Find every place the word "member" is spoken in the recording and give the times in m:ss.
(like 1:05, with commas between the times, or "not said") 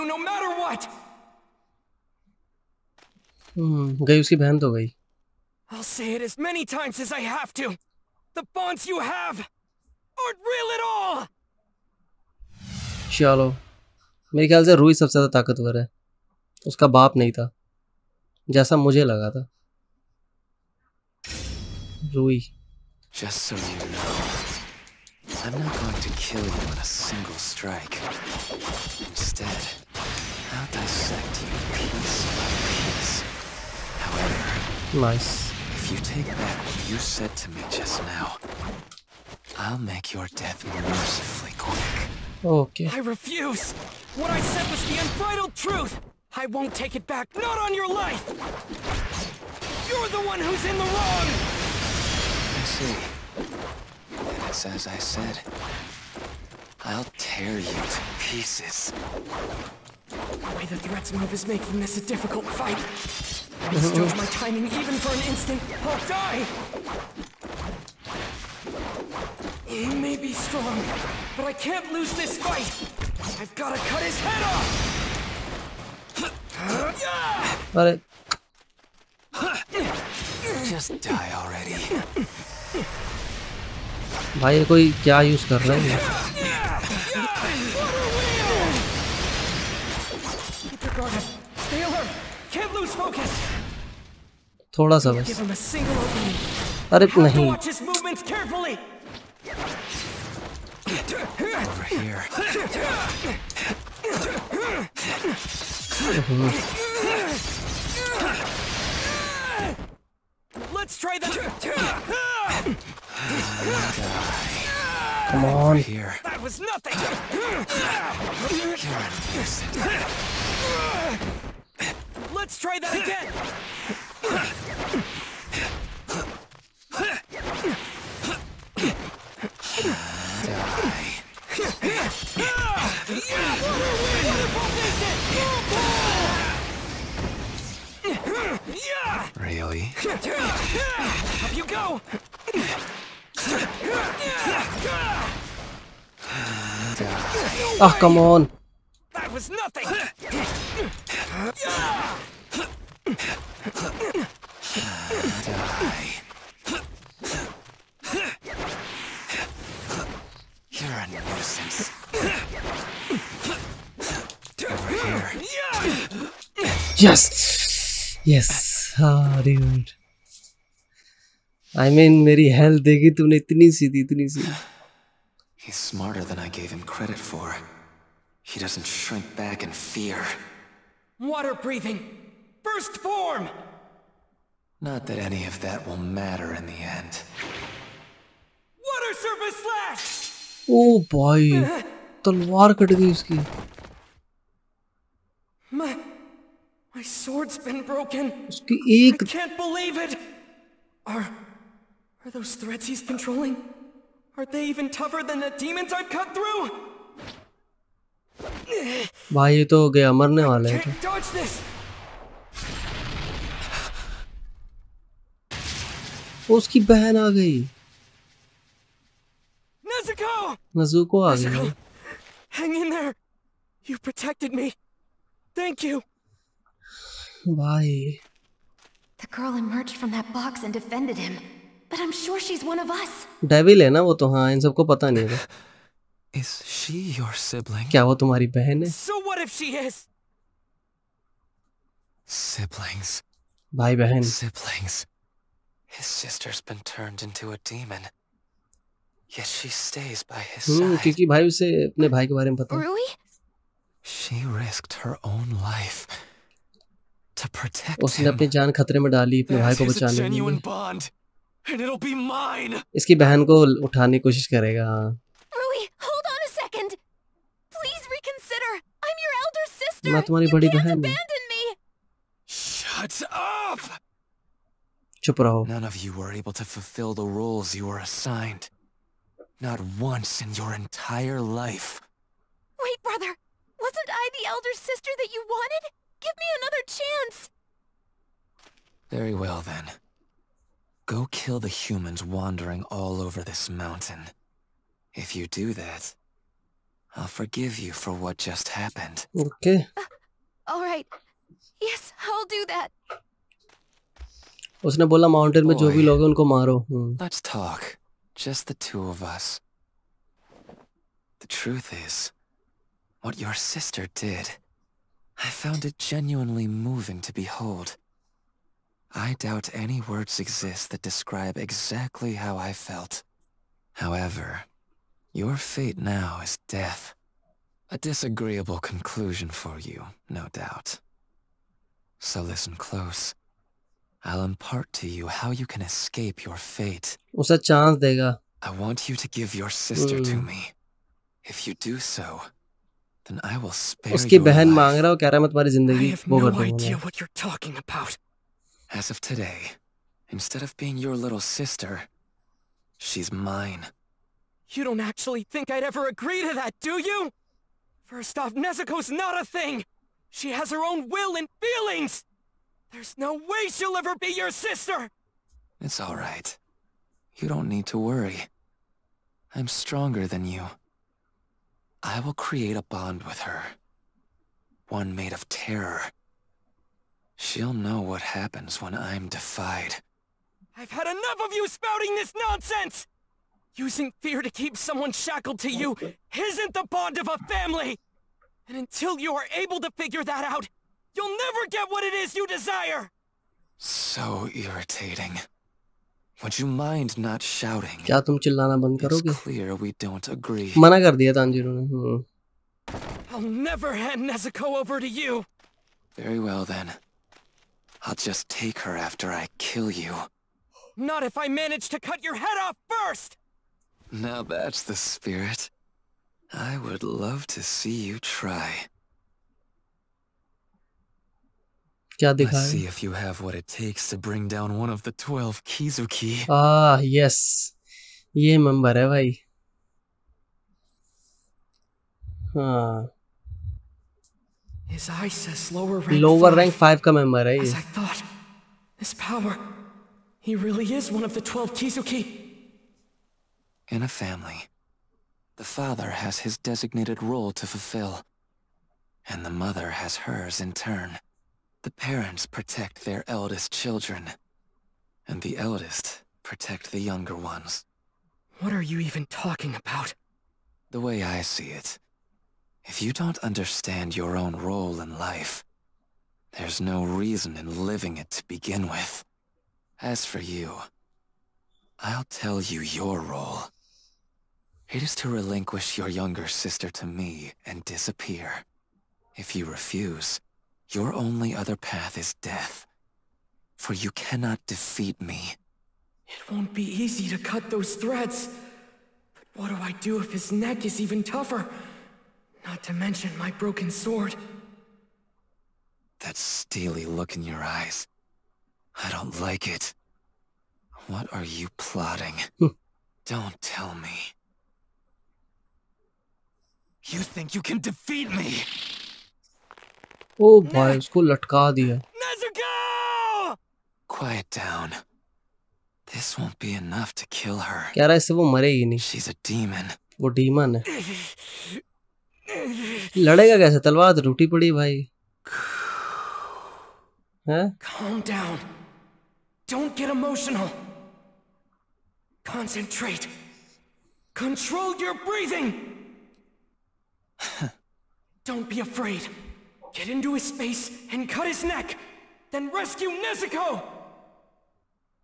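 7:08, 7:17.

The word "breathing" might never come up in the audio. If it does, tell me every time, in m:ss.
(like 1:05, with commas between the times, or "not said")
3:01, 8:55.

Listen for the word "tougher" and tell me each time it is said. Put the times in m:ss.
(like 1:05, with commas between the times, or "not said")
3:24, 8:11.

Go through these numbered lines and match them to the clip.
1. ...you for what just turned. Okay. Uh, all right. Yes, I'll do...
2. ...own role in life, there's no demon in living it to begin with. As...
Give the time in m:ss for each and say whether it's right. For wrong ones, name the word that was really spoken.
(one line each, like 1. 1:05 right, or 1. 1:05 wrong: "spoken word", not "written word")
1. 4:57 wrong: "happened", not "turned"
2. 7:44 wrong: "reason", not "demon".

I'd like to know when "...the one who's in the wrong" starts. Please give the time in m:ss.
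0:50.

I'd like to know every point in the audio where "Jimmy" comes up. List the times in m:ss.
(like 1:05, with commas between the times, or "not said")
not said.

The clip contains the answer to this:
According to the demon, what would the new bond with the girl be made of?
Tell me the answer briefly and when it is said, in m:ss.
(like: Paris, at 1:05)
Terror, at 6:15.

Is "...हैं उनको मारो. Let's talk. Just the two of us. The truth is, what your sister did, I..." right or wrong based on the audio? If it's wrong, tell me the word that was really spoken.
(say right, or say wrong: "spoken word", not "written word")
right.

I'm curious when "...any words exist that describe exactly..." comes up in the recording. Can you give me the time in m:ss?
5:19.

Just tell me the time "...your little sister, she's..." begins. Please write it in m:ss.
5:50.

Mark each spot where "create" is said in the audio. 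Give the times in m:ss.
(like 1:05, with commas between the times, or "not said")
6:12.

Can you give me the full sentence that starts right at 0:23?
Just so you know, I'm not going to kill you in a single strike.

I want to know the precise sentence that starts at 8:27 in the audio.
You think you can defeat me?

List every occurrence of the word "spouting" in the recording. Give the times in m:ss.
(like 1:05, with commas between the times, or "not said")
6:21.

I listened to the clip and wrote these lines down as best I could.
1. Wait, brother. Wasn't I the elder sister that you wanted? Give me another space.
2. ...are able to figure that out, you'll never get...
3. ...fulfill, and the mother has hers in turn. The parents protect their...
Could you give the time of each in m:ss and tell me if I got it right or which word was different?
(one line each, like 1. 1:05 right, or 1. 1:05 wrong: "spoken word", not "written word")
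1. 4:42 wrong: "chance", not "space"
2. 6:29 right
3. 7:27 right.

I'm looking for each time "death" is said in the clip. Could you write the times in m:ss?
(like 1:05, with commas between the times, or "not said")
0:40, 5:26, 8:02.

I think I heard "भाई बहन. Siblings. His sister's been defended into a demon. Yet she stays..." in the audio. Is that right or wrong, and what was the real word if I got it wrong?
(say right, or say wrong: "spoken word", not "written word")
wrong: "turned", not "defended".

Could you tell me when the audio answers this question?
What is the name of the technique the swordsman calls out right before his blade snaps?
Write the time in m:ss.
3:08.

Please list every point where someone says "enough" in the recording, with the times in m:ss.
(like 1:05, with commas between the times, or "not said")
6:21, 8:36.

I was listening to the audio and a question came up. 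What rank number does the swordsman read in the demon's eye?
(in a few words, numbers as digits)
5.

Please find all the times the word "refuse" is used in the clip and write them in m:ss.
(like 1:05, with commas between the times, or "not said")
0:42, 7:59.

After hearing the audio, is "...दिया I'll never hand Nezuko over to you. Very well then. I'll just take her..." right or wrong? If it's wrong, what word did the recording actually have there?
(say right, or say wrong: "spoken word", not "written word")
right.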